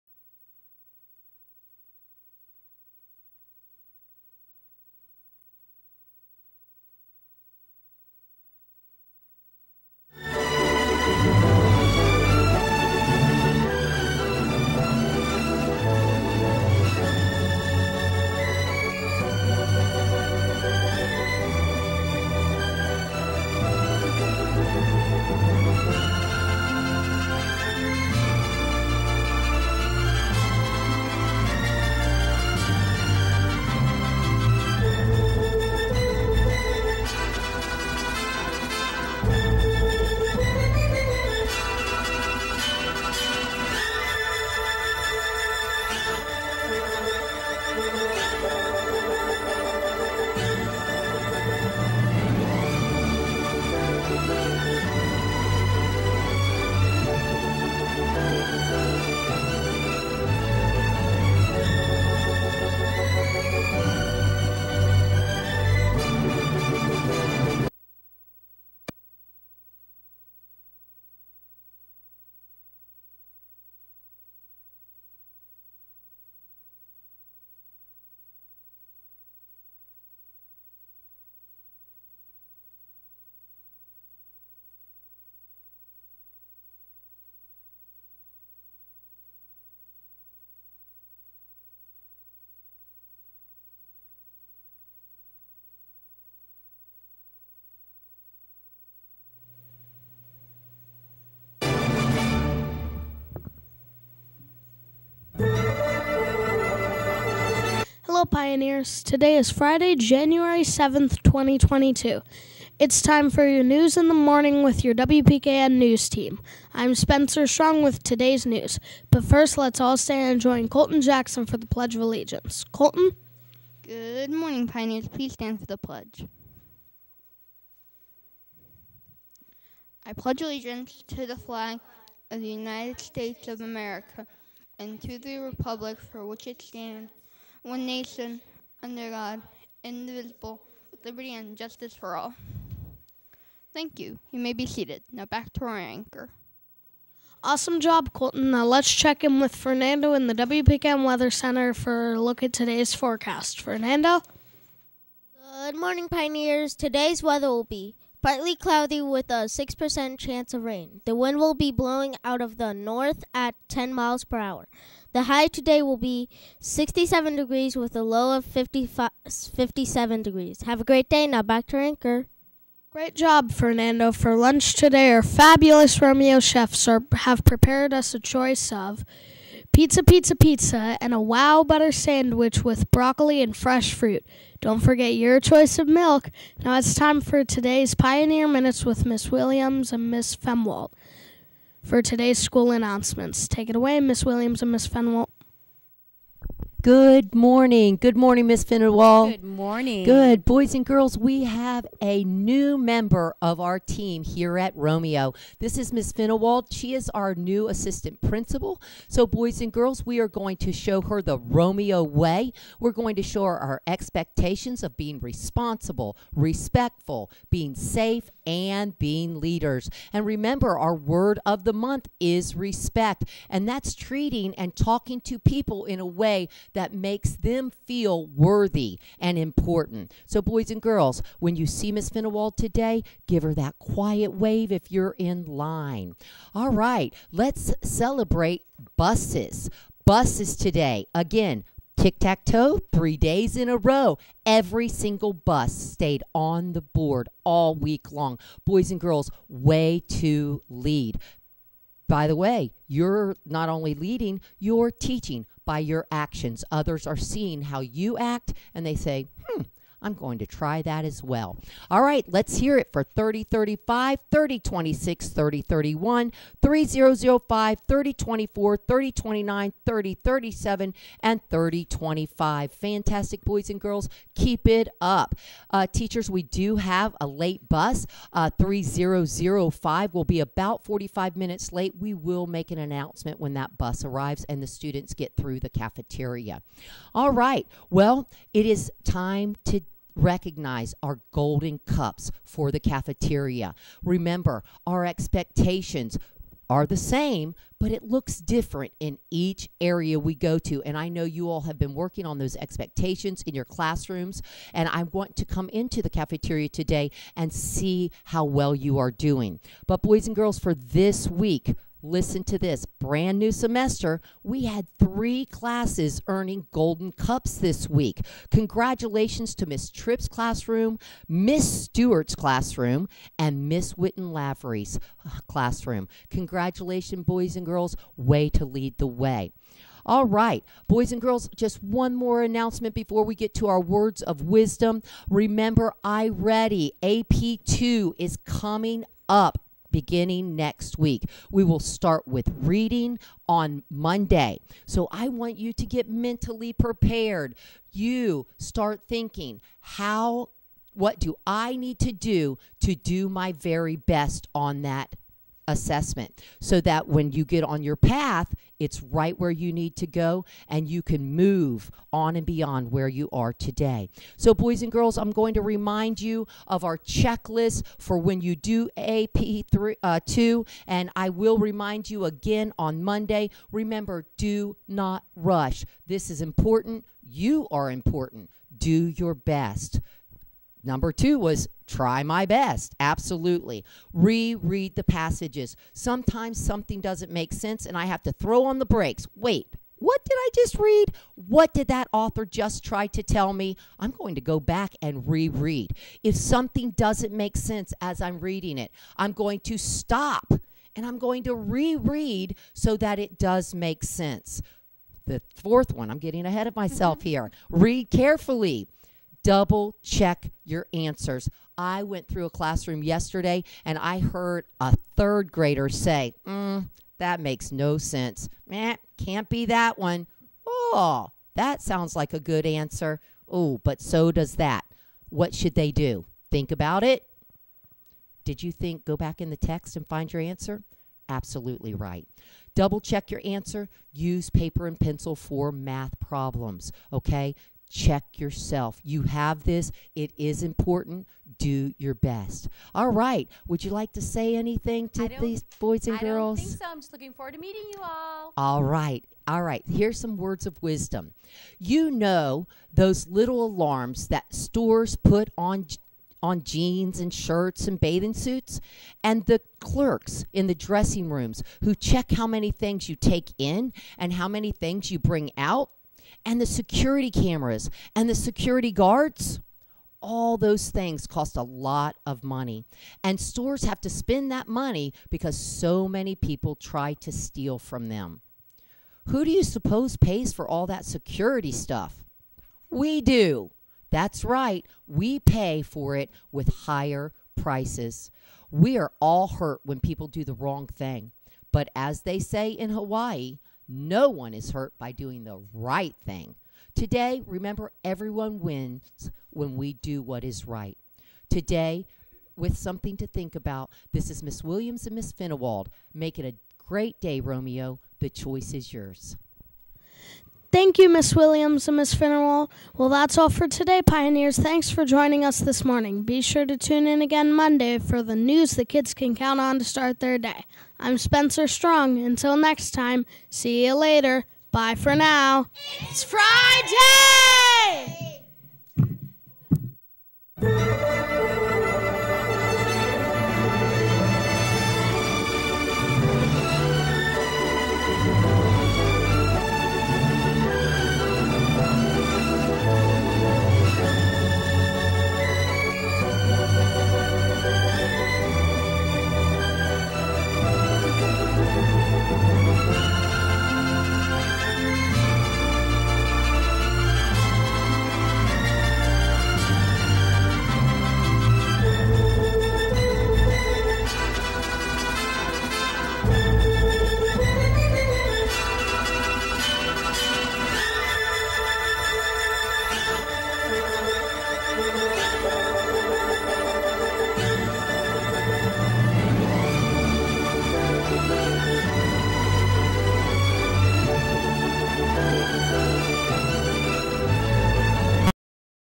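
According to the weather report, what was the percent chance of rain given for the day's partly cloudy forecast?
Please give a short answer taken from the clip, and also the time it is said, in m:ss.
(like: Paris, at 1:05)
6%, at 2:39.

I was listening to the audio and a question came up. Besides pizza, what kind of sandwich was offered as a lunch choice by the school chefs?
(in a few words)
Wow butter sandwich.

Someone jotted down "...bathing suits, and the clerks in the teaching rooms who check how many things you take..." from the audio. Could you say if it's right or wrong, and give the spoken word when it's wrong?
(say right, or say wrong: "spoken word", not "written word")
wrong: "dressing", not "teaching".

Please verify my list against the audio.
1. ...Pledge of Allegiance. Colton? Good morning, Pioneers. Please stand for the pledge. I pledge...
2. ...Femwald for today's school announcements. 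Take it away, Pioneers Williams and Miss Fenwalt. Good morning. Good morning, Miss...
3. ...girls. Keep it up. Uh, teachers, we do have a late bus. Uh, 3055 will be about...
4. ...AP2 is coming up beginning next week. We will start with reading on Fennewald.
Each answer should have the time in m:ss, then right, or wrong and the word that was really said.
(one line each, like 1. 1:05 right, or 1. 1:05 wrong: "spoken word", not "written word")
1. 2:01 right
2. 3:10 wrong: "Miss", not "Pioneers"
3. 4:33 wrong: "3005", not "3055"
4. 5:37 wrong: "Monday", not "Fennewald".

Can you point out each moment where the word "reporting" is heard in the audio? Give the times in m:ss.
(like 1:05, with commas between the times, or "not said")
not said.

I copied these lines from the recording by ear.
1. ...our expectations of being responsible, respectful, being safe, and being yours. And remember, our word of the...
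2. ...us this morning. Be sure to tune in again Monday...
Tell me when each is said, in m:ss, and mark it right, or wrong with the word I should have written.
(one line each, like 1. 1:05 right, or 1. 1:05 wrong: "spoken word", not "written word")
1. 3:33 wrong: "leaders", not "yours"
2. 8:35 right.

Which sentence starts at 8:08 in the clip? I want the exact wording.
We are all hurt when people do the wrong thing.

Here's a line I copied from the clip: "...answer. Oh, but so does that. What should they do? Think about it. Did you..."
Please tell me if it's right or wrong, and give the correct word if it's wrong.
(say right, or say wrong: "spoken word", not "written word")
right.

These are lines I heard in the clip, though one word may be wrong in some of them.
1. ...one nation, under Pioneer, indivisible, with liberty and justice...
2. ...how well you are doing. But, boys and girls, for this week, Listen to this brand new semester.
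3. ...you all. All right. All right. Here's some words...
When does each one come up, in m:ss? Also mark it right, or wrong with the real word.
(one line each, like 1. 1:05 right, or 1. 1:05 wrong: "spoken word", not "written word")
1. 2:17 wrong: "God", not "Pioneer"
2. 5:08 right
3. 7:27 right.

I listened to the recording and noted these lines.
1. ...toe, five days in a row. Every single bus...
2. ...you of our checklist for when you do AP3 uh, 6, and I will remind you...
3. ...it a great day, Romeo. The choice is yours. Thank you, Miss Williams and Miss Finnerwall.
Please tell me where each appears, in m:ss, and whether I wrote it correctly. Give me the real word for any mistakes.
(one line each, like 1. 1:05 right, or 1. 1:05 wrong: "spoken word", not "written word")
1. 4:02 wrong: "three", not "five"
2. 6:06 wrong: "2", not "6"
3. 8:26 right.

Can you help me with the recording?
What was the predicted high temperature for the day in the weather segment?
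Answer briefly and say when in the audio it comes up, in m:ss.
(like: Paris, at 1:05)
67 degrees, at 2:46.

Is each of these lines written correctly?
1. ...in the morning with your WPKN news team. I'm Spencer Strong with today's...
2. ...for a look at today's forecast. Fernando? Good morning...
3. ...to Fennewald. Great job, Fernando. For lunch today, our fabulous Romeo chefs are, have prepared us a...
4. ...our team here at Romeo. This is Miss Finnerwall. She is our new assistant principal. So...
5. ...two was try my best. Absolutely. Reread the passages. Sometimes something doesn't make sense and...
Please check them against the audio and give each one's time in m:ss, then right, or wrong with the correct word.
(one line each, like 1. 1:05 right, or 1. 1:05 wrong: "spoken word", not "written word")
1. 1:53 right
2. 2:31 right
3. 2:51 wrong: "Anchor", not "Fennewald"
4. 3:23 right
5. 6:21 right.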